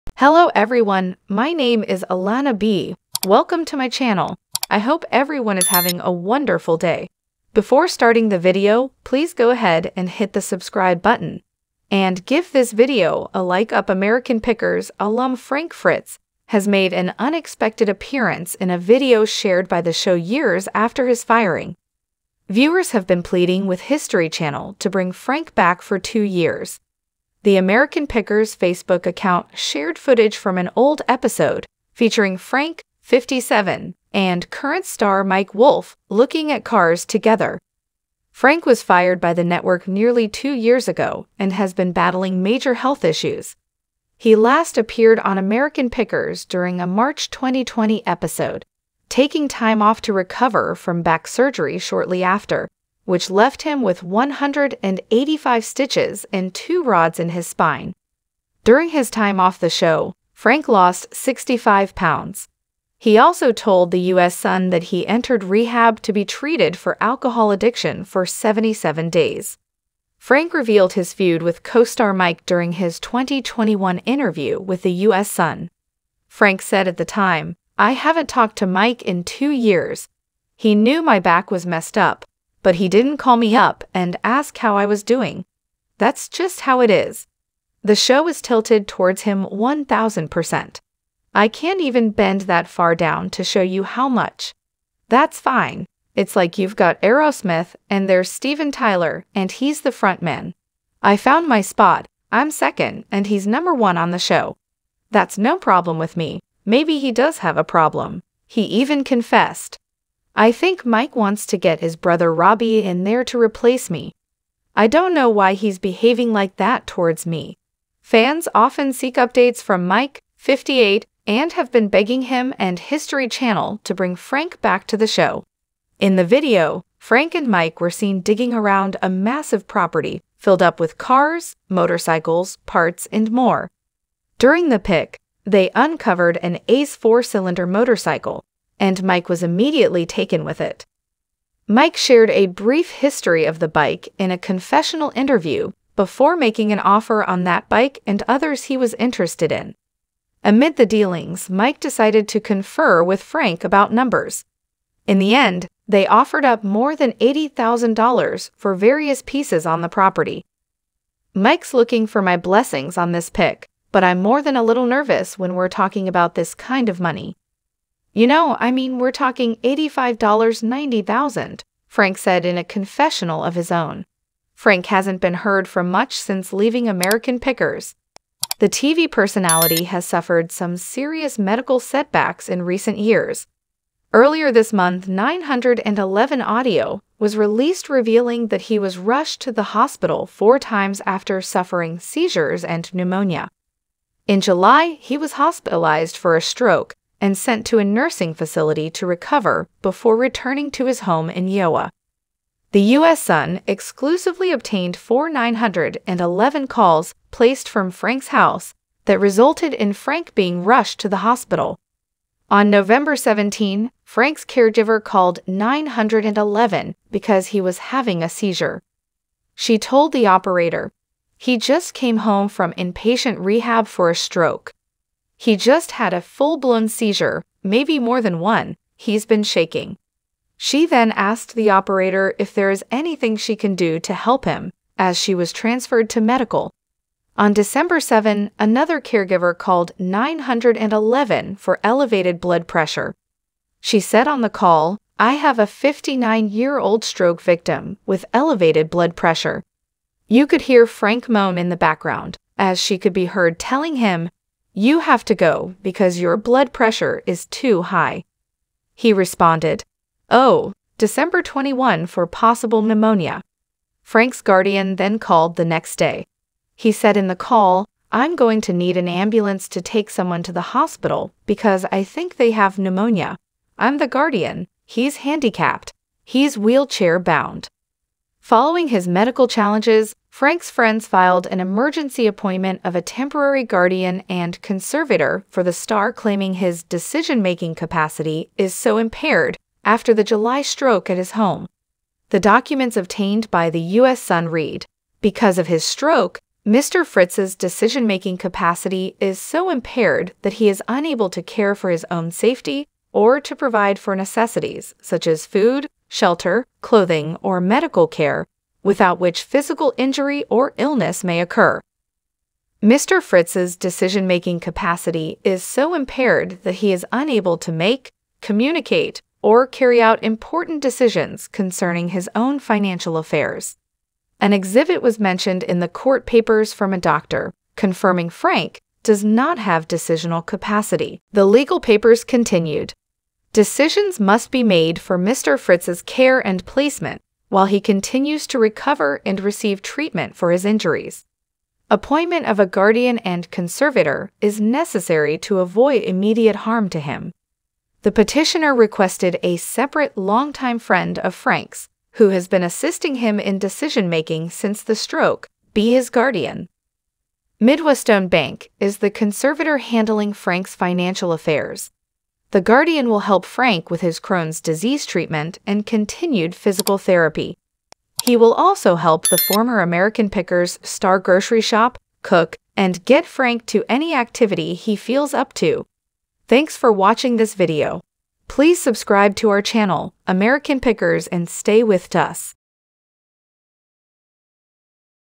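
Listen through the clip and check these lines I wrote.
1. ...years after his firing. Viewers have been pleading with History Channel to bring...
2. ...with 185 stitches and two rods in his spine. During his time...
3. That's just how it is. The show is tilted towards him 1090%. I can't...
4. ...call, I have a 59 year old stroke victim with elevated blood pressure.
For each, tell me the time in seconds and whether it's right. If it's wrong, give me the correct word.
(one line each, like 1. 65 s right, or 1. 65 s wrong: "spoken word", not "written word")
1. 20 s right
2. 53 s right
3. 85 s wrong: "1000", not "1090"
4. 244 s right.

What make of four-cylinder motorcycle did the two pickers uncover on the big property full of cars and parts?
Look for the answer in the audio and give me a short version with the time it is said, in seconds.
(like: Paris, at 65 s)
Ace, at 136 s.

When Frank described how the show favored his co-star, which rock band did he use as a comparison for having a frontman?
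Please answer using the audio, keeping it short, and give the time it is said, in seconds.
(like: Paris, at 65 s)
Aerosmith, at 97 s.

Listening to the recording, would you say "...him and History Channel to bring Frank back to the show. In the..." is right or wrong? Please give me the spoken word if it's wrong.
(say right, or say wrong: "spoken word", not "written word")
right.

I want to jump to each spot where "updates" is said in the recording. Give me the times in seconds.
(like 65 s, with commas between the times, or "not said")
119 s.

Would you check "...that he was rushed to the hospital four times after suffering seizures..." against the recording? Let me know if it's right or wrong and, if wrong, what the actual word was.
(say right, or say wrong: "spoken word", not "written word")
right.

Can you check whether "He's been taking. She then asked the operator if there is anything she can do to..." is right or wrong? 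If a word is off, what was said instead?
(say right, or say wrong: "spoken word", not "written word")
wrong: "shaking", not "taking".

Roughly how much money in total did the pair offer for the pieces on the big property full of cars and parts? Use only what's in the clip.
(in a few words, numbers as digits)
$80,000.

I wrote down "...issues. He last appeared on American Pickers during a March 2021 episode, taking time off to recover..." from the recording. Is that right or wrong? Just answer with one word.
wrong.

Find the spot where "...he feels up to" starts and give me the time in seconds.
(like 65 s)
374 s.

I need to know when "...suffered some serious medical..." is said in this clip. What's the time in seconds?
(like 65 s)
180 s.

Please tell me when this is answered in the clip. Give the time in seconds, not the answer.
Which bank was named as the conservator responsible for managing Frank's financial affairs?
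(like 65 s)
357 s.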